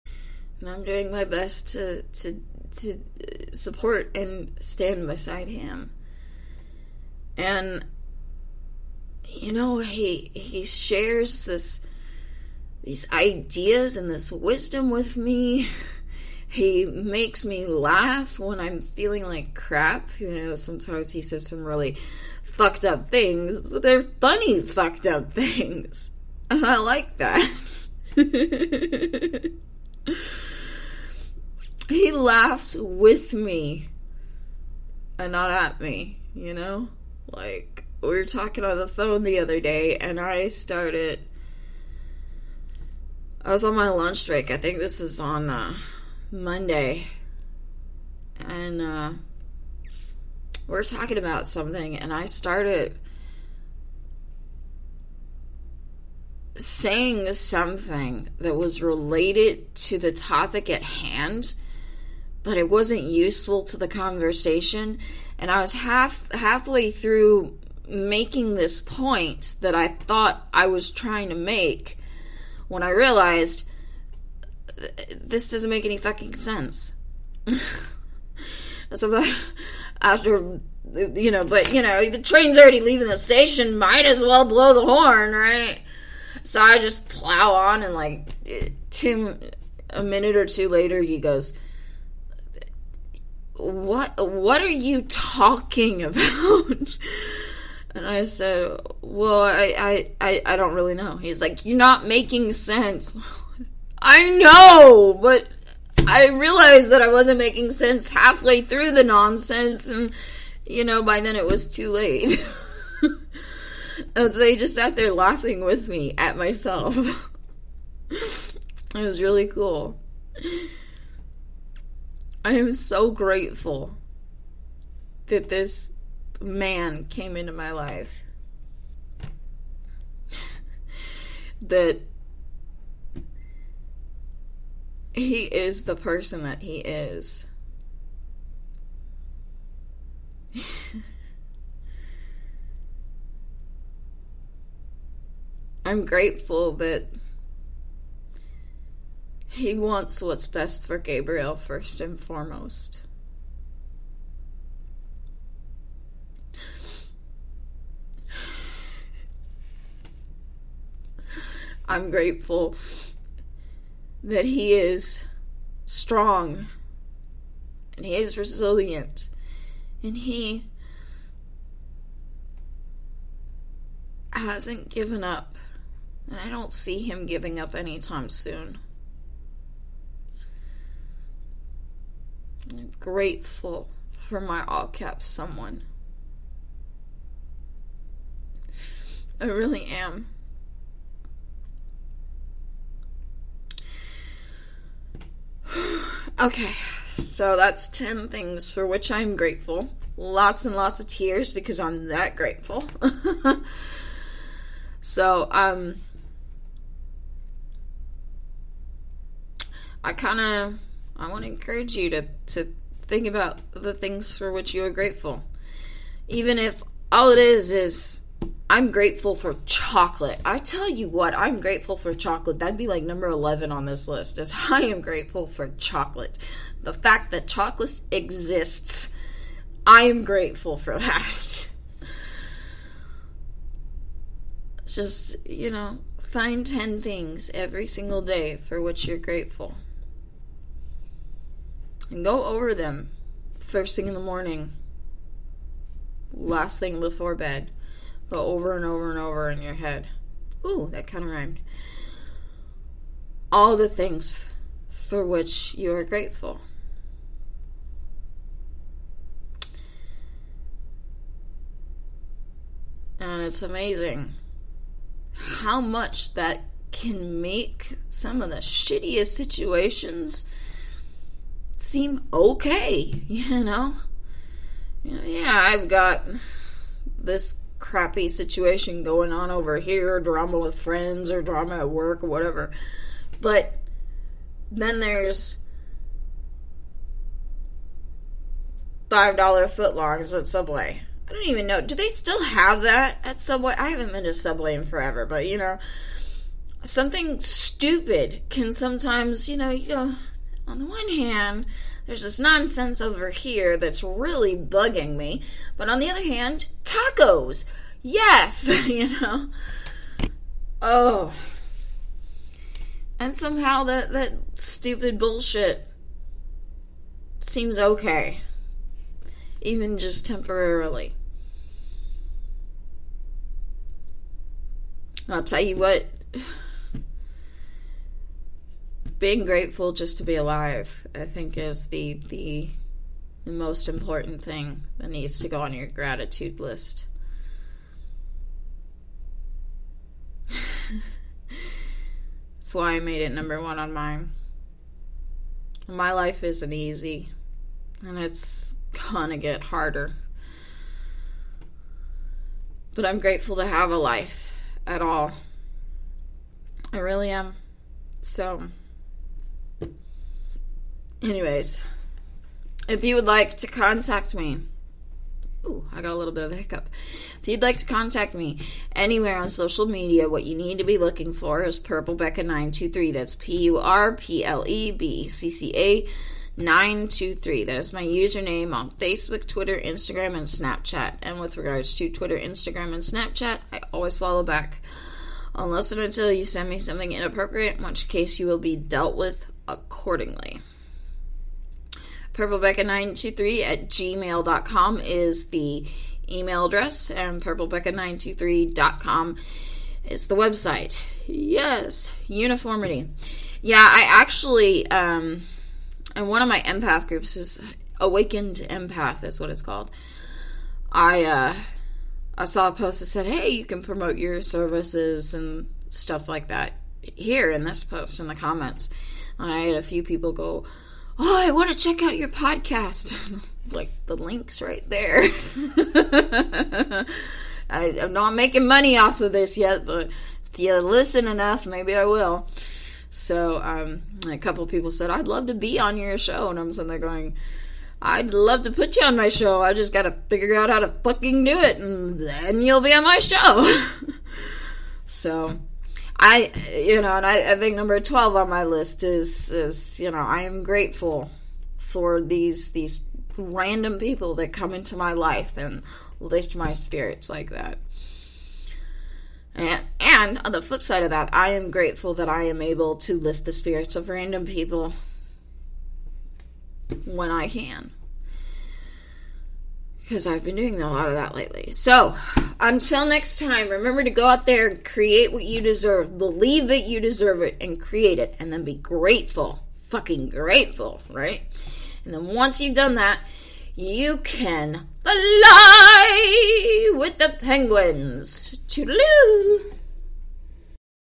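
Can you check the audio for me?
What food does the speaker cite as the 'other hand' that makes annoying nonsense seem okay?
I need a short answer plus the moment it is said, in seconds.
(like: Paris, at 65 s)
Tacos, at 306 s.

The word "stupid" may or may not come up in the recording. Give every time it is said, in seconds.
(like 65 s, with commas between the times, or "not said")
297 s, 314 s.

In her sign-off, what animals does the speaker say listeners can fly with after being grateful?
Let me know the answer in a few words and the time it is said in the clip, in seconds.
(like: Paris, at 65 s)
Penguins, at 487 s.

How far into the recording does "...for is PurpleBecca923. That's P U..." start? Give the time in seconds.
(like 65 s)
371 s.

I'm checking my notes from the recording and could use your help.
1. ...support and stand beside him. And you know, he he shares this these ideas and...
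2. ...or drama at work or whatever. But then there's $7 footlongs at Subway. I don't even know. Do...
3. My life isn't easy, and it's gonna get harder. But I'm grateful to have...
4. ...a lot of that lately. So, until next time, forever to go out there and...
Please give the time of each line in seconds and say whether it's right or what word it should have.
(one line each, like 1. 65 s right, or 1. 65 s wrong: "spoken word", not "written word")
1. 3 s right
2. 281 s wrong: "5", not "7"
3. 345 s right
4. 470 s wrong: "remember", not "forever".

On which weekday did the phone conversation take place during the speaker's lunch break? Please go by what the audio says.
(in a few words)
Monday.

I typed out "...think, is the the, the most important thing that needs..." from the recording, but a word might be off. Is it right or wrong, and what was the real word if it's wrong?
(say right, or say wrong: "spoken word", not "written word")
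right.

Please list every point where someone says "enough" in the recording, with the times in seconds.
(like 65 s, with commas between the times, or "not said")
431 s.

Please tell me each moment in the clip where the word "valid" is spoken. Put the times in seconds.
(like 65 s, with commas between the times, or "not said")
not said.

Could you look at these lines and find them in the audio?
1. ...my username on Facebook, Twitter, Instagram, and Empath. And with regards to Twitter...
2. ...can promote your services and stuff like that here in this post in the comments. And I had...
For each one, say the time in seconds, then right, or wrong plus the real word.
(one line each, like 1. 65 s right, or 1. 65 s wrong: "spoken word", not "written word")
1. 377 s wrong: "Snapchat", not "Empath"
2. 413 s right.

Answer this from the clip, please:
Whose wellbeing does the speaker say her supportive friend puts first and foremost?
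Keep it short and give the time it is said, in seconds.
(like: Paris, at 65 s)
Gabriel, at 150 s.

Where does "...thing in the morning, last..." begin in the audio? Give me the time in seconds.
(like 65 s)
243 s.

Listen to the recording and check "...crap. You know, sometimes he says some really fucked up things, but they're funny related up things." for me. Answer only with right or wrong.
wrong.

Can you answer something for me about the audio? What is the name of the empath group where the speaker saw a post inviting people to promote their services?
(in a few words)
Awakened Empath.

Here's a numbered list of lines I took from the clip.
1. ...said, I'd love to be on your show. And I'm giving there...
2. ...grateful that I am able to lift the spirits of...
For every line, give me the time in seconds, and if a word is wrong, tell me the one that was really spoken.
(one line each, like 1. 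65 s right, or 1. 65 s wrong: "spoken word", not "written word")
1. 434 s wrong: "sitting", not "giving"
2. 461 s right.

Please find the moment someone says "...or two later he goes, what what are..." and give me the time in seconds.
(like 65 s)
90 s.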